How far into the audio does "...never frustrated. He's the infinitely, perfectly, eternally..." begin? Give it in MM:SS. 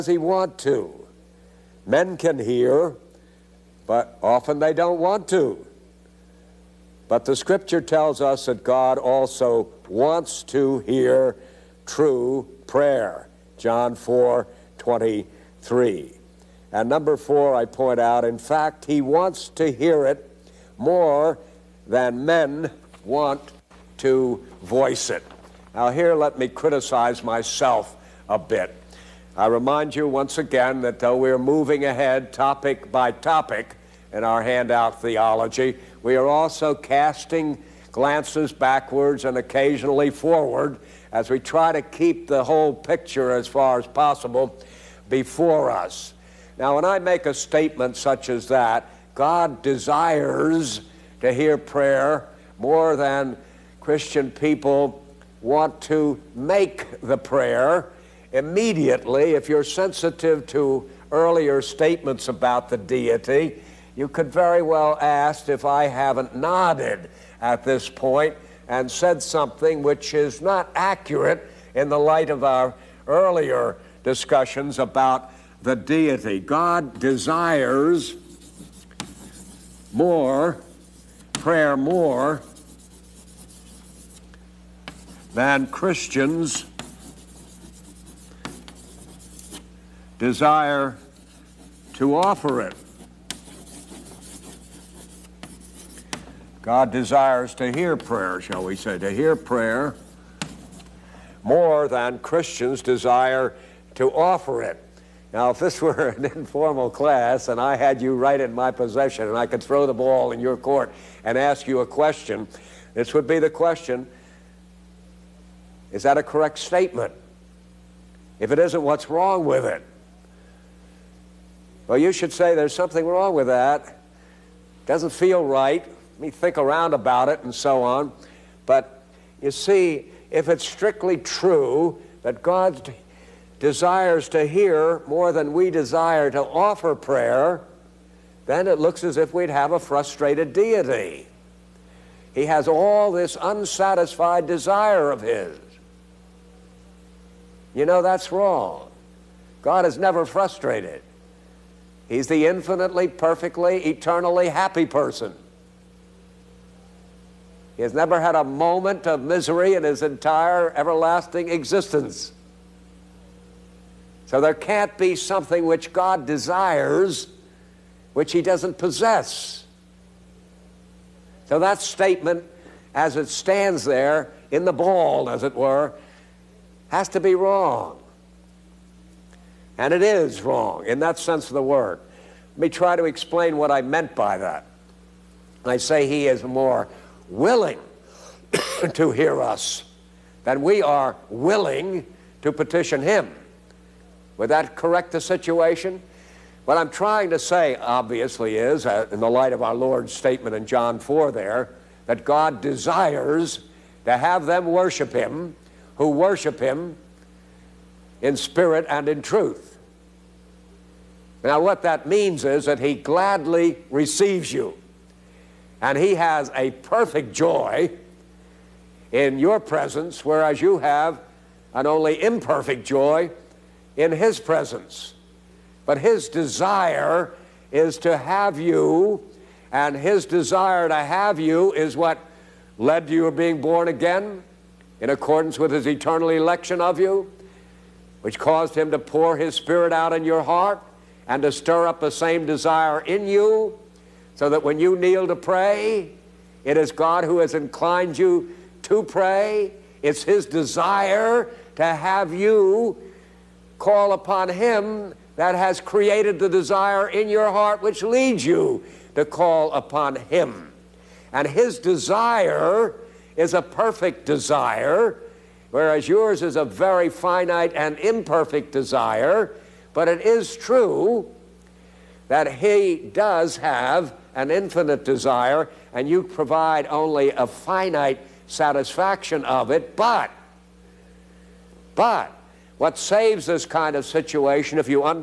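02:29.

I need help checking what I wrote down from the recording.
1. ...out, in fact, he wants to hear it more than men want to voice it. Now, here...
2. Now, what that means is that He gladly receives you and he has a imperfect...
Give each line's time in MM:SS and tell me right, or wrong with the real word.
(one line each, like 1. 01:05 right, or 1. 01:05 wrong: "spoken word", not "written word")
1. 00:17 right
2. 03:31 wrong: "perfect", not "imperfect".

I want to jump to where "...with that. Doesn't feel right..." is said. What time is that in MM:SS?
02:03.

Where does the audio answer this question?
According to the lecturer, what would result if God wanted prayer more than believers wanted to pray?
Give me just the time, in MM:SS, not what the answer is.
02:19.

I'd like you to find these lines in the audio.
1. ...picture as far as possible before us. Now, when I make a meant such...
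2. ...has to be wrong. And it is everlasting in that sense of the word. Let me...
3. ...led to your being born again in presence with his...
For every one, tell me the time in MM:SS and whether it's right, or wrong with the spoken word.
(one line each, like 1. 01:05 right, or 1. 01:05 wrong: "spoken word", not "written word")
1. 00:42 wrong: "statement", not "meant"
2. 02:56 wrong: "wrong", not "everlasting"
3. 03:52 wrong: "accordance", not "presence".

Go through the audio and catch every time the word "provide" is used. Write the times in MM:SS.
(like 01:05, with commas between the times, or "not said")
04:36.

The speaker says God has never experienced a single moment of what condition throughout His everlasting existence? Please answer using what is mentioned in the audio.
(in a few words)
Misery.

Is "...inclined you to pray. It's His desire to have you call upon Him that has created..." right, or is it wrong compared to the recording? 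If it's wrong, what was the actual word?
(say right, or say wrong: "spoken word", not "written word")
right.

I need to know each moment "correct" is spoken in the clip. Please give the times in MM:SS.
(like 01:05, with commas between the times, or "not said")
01:56, 03:14.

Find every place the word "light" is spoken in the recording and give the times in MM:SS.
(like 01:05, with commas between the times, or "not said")
01:11, 03:19.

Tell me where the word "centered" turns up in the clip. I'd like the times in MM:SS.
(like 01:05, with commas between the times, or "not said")
not said.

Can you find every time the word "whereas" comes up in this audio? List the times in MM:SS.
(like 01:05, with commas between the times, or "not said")
03:40, 04:25.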